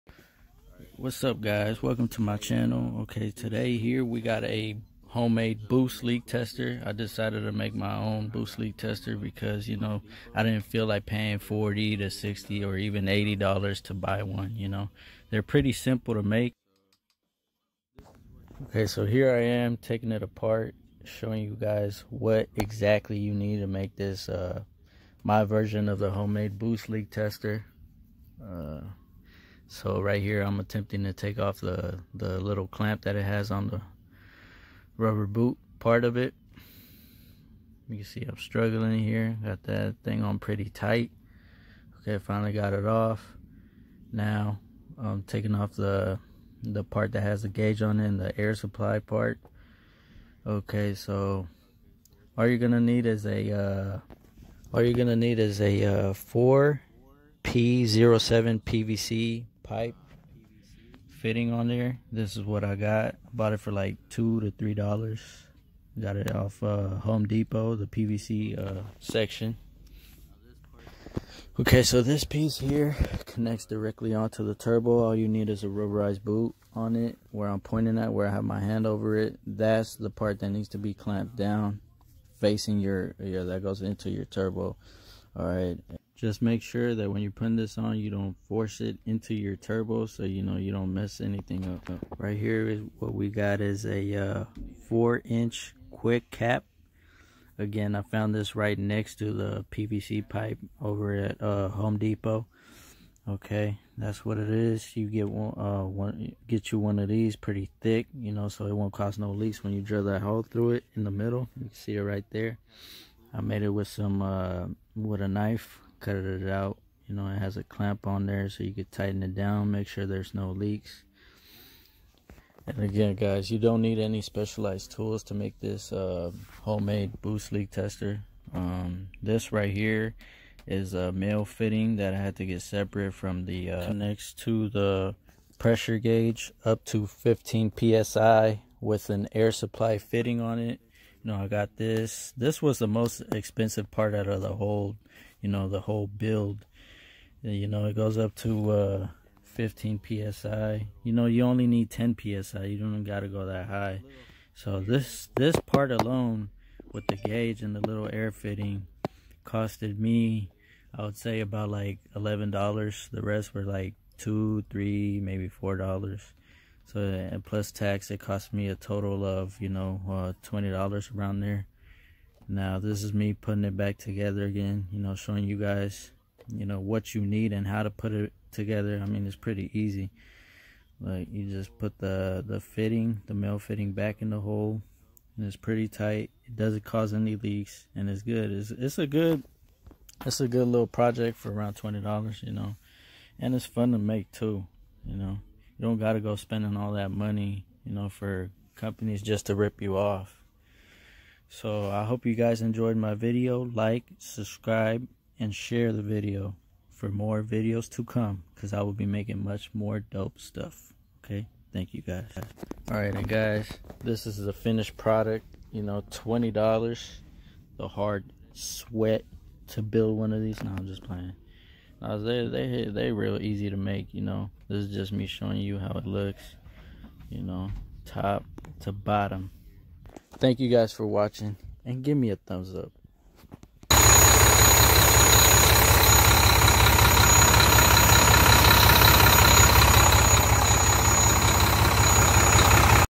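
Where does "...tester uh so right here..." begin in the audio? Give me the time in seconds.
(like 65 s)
27 s.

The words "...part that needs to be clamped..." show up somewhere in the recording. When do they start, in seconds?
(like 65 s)
80 s.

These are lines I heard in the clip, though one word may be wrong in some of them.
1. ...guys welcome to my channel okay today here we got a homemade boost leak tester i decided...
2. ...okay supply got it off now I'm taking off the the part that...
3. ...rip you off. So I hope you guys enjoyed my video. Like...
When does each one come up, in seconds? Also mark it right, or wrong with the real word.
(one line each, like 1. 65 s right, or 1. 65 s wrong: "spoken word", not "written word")
1. 1 s right
2. 42 s wrong: "finally", not "supply"
3. 199 s right.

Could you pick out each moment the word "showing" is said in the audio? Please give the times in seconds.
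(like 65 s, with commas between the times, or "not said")
21 s, 175 s, 225 s.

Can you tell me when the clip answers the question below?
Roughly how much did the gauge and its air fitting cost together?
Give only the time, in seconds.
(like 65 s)
162 s.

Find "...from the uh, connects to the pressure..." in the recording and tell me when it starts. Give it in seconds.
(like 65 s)
133 s.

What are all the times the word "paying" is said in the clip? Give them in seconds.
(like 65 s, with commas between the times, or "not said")
11 s.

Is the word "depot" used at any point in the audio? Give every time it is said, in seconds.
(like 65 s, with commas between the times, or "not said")
67 s, 101 s.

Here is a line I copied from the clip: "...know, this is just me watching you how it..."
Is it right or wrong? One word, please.
wrong.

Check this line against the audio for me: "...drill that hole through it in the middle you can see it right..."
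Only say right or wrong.
right.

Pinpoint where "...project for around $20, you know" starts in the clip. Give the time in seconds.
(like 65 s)
190 s.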